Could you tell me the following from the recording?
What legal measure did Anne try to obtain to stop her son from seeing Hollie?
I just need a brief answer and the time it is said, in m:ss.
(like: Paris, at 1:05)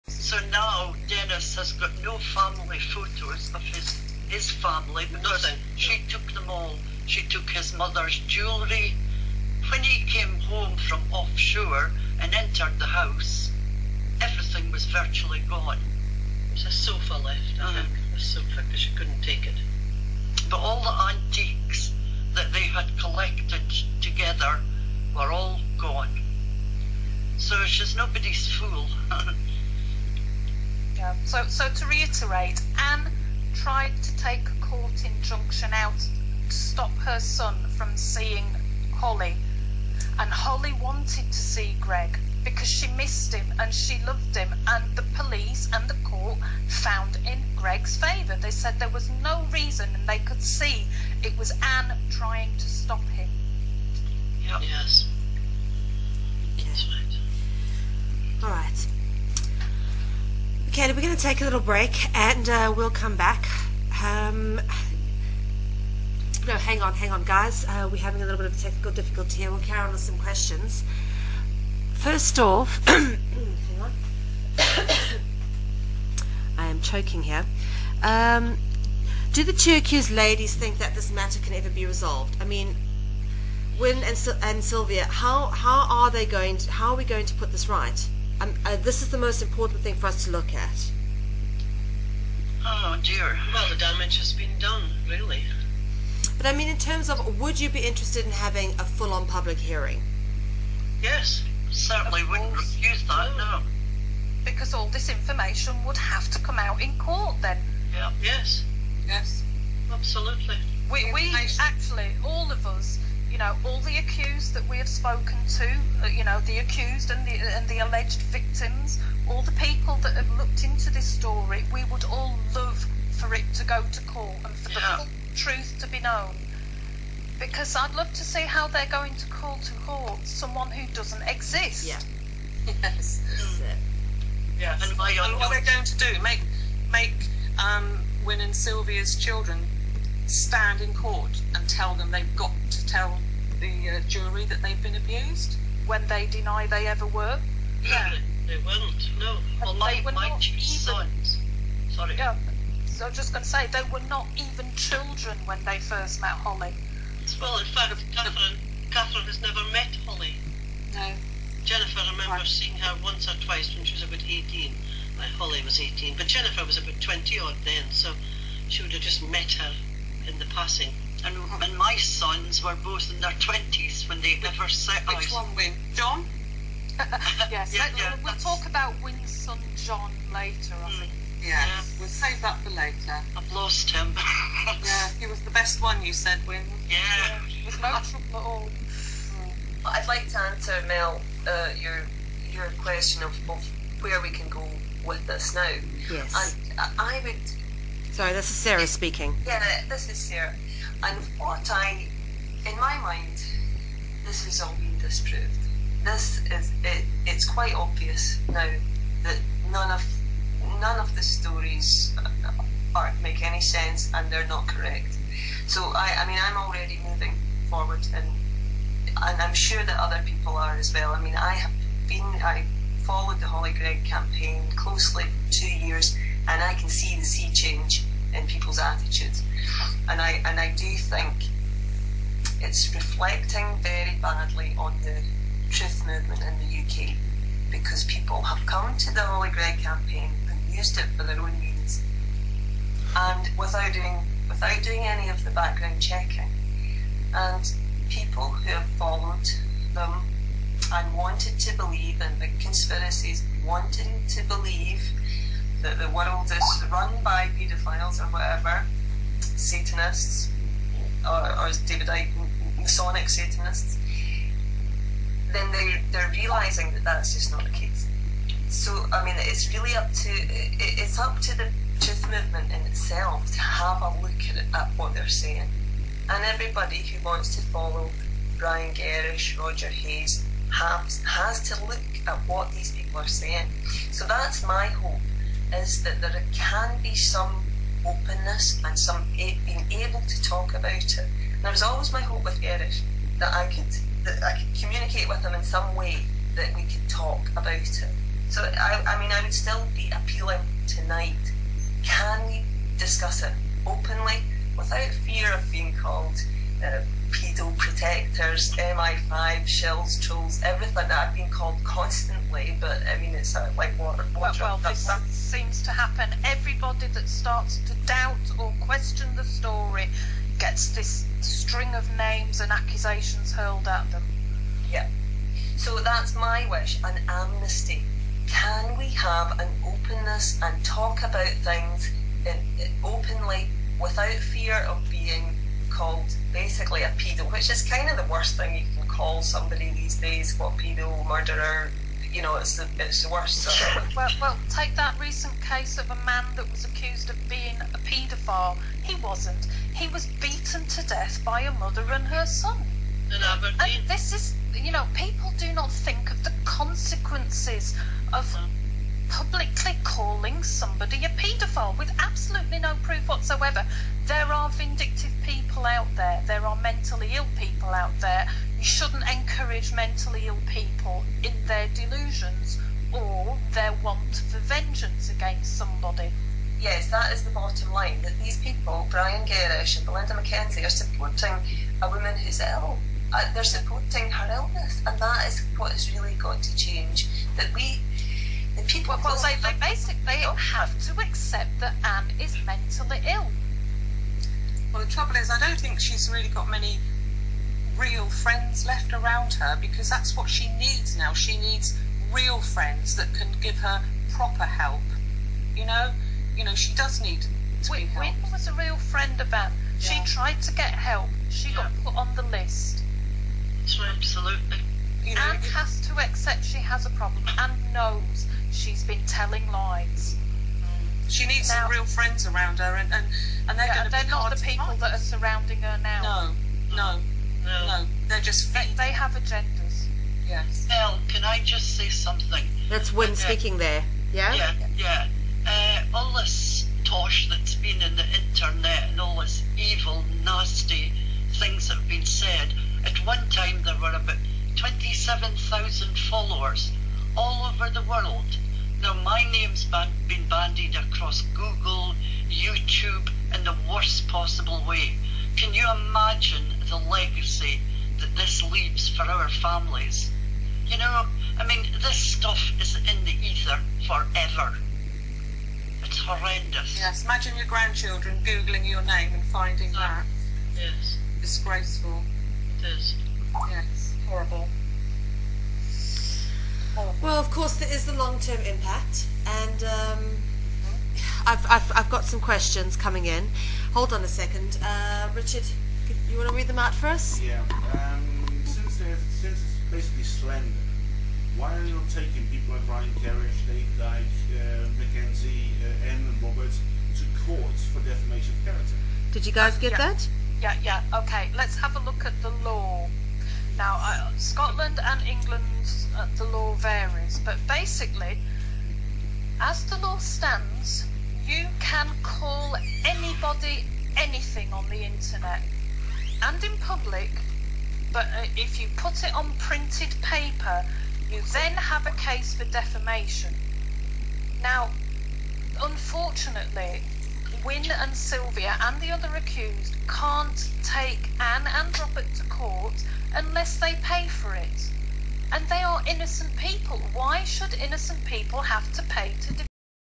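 Court injunction, at 0:34.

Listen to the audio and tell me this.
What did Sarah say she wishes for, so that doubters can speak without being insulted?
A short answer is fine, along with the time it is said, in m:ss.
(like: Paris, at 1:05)
An amnesty, at 5:27.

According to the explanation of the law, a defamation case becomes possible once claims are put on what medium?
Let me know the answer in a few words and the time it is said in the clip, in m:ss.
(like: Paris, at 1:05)
Printed paper, at 8:39.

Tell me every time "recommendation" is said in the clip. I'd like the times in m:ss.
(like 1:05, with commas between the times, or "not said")
not said.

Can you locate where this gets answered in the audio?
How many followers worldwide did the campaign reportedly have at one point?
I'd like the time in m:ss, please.
7:24.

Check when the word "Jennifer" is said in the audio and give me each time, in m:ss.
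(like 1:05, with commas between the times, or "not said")
2:41, 2:46.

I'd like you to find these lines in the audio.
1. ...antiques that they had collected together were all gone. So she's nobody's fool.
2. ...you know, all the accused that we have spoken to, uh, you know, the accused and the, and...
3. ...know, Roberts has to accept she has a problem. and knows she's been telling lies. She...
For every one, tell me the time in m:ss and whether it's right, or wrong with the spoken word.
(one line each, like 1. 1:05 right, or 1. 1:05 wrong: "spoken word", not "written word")
1. 0:21 right
2. 1:53 right
3. 6:55 wrong: "Anne", not "Roberts".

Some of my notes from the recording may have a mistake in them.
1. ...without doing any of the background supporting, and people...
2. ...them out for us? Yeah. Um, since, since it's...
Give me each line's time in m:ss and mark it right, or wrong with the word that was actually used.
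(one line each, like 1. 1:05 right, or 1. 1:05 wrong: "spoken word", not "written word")
1. 4:04 wrong: "checking", not "supporting"
2. 8:06 right.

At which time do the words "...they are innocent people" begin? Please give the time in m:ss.
8:55.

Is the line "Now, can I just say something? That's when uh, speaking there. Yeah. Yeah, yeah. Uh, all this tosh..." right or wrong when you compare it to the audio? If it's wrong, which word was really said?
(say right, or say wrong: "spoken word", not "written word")
right.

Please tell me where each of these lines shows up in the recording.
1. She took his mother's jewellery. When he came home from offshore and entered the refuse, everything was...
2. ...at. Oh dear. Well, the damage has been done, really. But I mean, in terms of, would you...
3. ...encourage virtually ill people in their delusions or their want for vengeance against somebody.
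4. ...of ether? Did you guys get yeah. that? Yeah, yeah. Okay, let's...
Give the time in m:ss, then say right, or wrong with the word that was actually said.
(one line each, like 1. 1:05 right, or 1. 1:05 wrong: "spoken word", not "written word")
1. 0:07 wrong: "house", not "refuse"
2. 1:30 right
3. 6:09 wrong: "mentally", not "virtually"
4. 8:18 wrong: "character", not "ether".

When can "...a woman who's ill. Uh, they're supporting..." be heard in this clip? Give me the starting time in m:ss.
6:22.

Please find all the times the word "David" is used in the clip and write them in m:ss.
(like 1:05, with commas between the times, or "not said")
4:21, 8:13.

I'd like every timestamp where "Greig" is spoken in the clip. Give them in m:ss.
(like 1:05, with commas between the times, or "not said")
3:43, 3:59.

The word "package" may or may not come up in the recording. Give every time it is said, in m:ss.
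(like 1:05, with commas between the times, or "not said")
not said.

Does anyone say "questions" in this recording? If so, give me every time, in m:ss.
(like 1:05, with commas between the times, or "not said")
1:10, 3:12, 5:18, 8:02.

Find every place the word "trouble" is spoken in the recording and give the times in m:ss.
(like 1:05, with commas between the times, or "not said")
3:08, 6:35.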